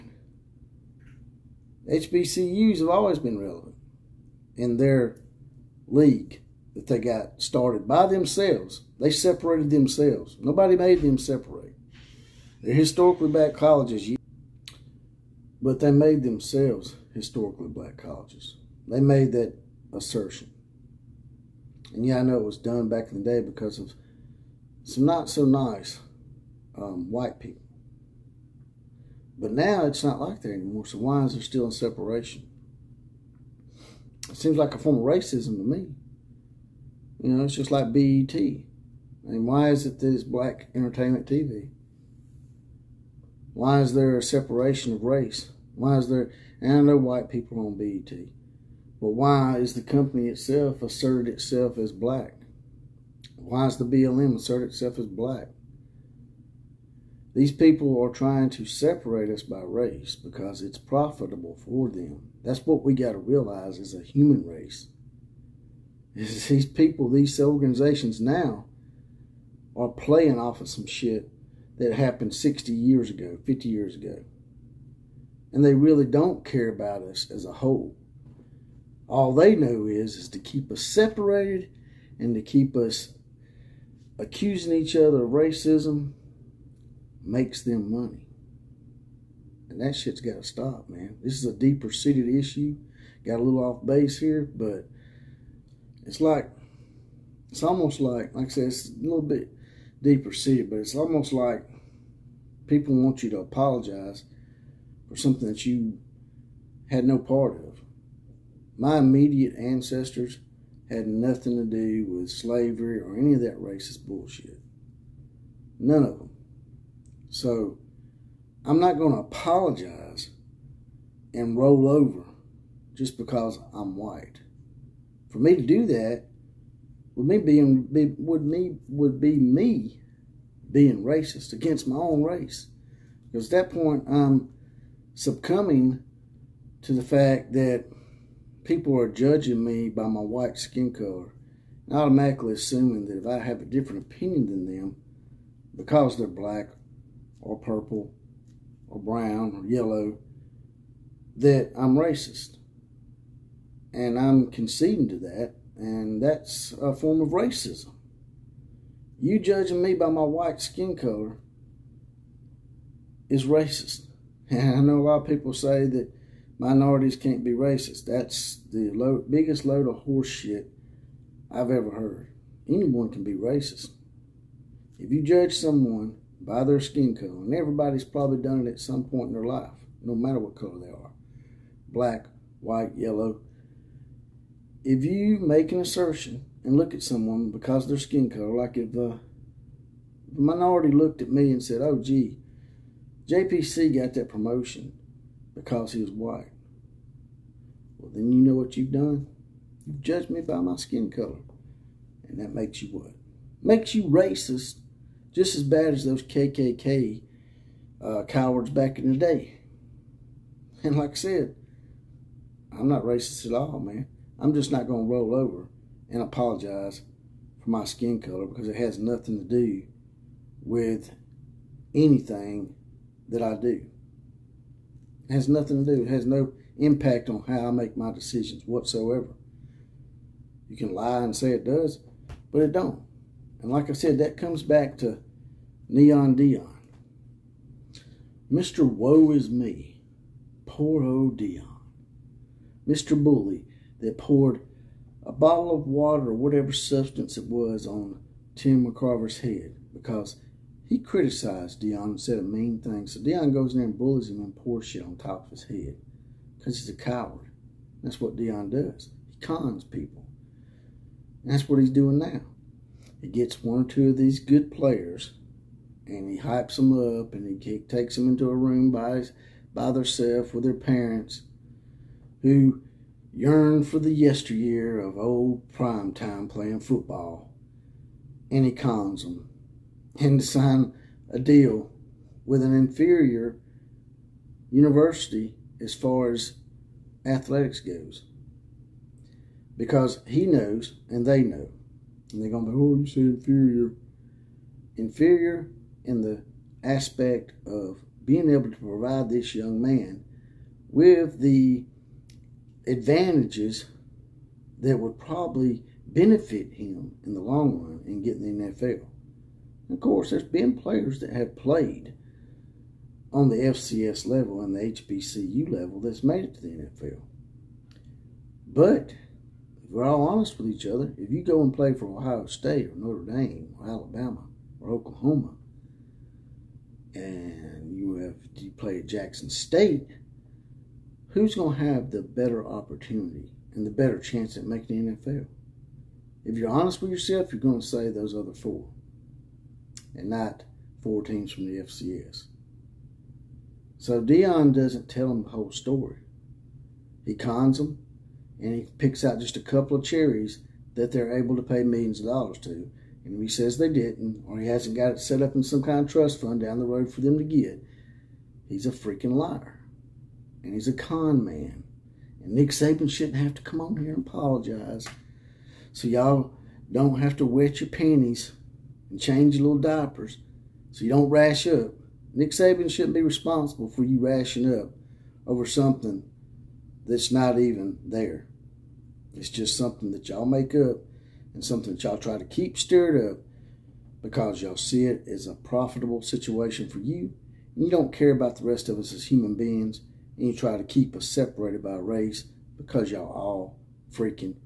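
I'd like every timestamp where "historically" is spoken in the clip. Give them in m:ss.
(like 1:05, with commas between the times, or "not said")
0:12, 0:17.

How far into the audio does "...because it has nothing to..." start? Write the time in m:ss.
3:38.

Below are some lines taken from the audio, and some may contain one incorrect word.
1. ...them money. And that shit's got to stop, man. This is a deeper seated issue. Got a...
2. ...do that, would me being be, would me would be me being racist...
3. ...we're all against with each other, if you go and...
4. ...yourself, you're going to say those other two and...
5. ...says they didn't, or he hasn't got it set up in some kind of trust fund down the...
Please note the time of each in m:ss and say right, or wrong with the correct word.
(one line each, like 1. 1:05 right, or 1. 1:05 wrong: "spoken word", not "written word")
1. 1:27 right
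2. 2:05 right
3. 5:19 wrong: "honest", not "against"
4. 5:37 wrong: "four", not "two"
5. 5:53 right.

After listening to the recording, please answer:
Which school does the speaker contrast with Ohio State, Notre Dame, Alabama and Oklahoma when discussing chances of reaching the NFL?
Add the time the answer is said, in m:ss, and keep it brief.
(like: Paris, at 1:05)
Jackson State, at 5:29.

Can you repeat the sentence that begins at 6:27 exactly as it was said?
And you don't care about the rest of us as human beings.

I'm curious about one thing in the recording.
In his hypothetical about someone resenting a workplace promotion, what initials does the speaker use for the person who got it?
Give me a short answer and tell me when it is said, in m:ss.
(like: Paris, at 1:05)
JPC, at 3:13.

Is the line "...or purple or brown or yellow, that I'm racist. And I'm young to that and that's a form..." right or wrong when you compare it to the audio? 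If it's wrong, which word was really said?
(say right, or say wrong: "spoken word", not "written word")
wrong: "conceding", not "young".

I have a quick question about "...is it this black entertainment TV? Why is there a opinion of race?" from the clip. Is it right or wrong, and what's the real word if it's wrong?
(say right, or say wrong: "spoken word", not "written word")
wrong: "separation", not "opinion".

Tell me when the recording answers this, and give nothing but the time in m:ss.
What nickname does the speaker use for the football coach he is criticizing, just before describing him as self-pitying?
3:55.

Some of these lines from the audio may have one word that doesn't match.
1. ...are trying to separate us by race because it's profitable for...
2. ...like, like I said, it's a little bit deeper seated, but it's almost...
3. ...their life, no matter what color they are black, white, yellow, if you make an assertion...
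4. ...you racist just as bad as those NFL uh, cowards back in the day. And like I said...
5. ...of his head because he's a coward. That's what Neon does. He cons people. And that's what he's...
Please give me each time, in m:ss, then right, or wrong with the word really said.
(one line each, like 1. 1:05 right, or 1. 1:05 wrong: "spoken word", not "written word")
1. 0:58 right
2. 1:37 right
3. 2:59 right
4. 3:23 wrong: "KKK", not "NFL"
5. 4:15 wrong: "Deion", not "Neon".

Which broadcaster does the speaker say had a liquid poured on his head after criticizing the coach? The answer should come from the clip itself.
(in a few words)
Tim McCarver.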